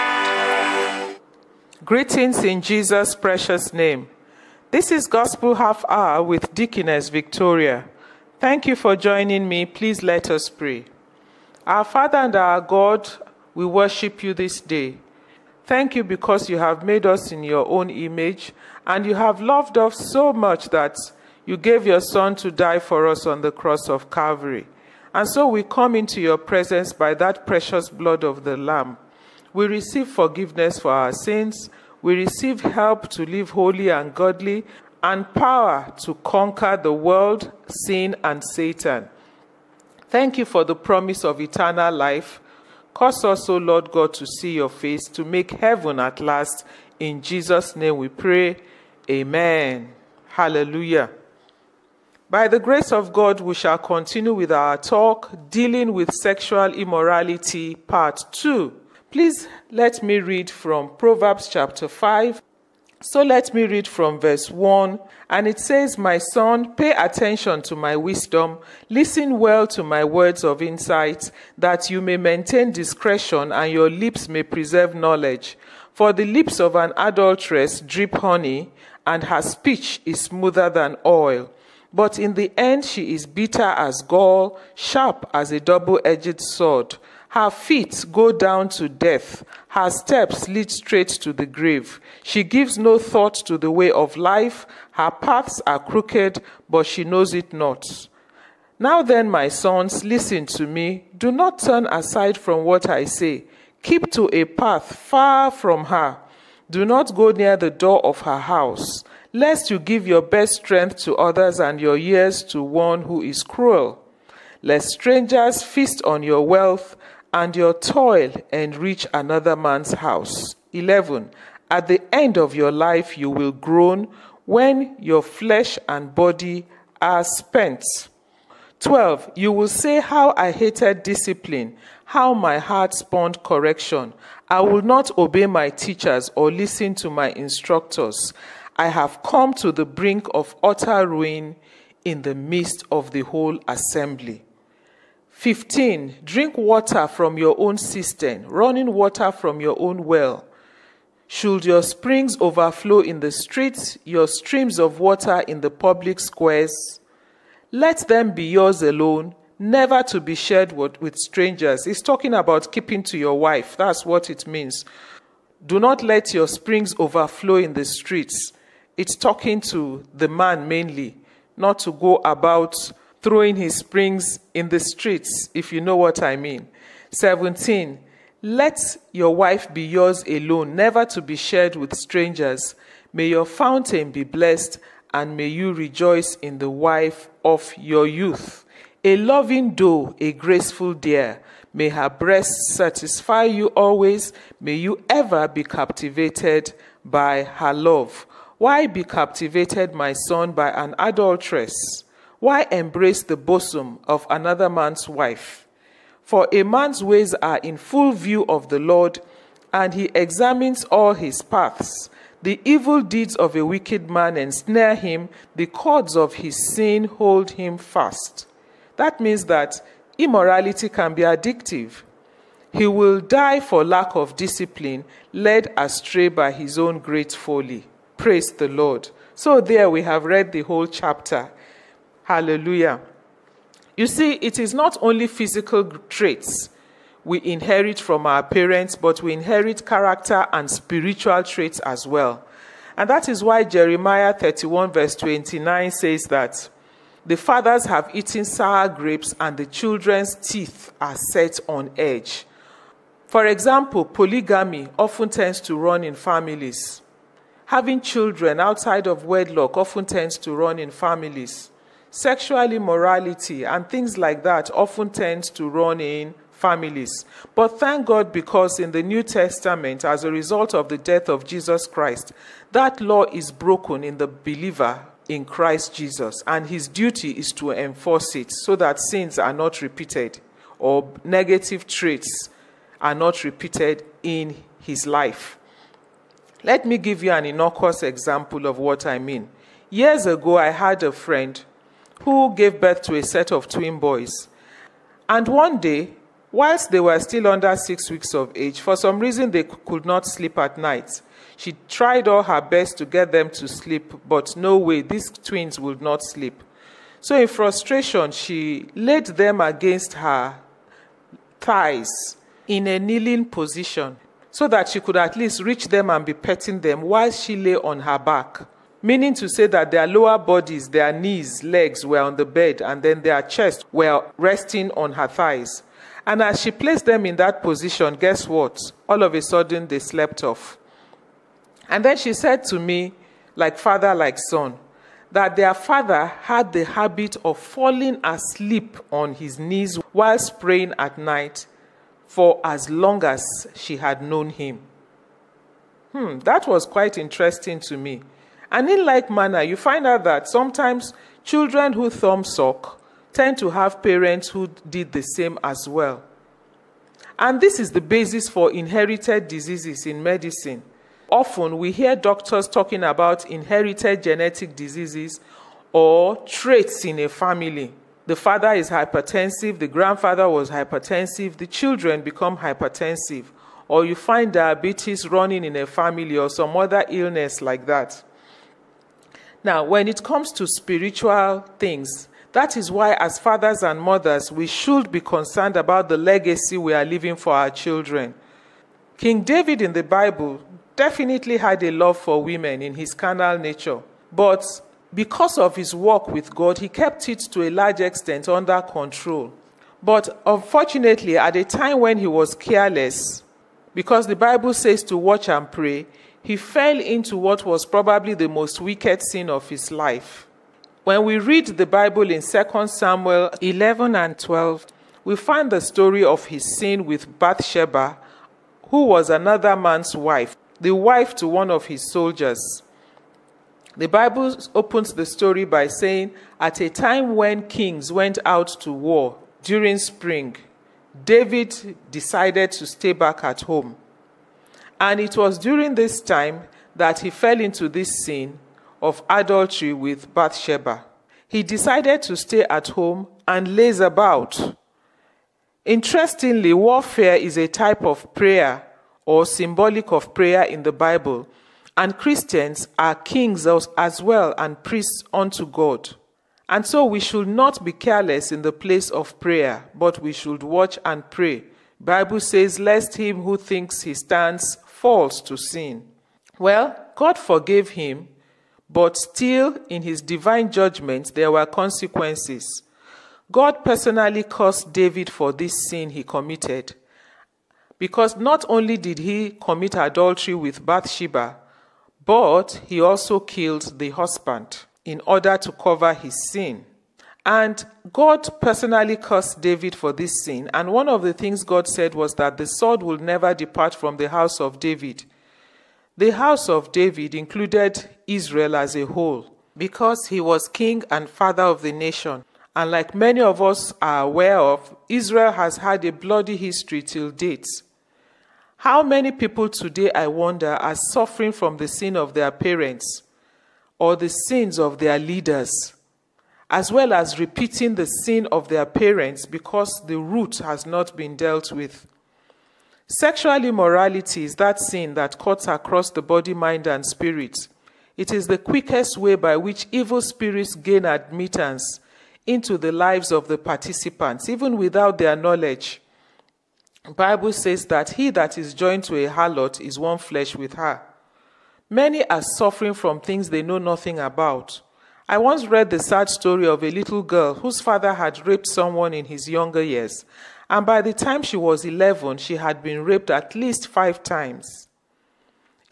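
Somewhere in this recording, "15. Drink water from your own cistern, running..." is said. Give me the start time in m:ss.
2:25.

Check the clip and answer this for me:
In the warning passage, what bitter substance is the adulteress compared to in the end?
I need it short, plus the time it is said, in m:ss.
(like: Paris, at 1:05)
gall, at 1:24.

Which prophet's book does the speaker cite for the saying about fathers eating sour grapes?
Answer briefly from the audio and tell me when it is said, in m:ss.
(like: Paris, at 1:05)
Jeremiah, at 4:03.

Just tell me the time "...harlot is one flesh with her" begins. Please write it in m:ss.
8:59.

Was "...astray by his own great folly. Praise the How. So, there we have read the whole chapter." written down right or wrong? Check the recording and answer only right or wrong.
wrong.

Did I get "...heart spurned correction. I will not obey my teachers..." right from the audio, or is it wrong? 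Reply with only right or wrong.
right.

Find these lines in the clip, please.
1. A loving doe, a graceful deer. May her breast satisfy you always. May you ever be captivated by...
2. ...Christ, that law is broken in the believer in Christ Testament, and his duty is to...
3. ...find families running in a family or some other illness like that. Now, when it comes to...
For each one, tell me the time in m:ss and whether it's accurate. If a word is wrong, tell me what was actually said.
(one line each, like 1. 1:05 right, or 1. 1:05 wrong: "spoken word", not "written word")
1. 3:09 right
2. 4:31 wrong: "Jesus", not "Testament"
3. 6:14 wrong: "diabetes", not "families".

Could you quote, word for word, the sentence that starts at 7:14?
And it was during this time that he fell into this sin of adultery with Bathsheba.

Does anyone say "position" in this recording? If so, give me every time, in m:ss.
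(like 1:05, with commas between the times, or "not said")
5:13, 5:27.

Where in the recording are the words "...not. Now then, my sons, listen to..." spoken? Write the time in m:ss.
1:37.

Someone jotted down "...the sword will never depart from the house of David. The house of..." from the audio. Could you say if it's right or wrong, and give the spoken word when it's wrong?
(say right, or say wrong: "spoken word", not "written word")
right.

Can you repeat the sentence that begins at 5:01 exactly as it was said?
She tried all her best to get them to sleep, but no way, these twins would not sleep.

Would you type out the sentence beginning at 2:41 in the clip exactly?
He's talking about keeping to your wife.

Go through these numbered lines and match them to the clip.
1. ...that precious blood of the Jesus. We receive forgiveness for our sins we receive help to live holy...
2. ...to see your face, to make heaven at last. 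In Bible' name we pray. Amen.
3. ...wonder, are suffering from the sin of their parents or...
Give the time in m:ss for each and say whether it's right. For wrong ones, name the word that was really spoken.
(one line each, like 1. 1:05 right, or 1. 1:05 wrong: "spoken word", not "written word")
1. 0:27 wrong: "Lamb", not "Jesus"
2. 0:44 wrong: "Jesus", not "Bible"
3. 8:30 right.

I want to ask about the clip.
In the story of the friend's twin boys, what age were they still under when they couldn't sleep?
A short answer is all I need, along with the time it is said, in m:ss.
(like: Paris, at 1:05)
6 weeks, at 4:57.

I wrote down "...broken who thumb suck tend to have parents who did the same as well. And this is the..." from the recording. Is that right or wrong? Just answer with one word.
wrong.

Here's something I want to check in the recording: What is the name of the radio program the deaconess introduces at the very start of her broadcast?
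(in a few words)
Gospel Half Hour.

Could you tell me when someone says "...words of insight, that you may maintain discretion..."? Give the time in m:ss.
1:10.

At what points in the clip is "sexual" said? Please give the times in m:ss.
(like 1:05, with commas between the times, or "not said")
0:56, 4:22, 8:43.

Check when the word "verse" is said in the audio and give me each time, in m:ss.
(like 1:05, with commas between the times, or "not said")
1:04, 4:04.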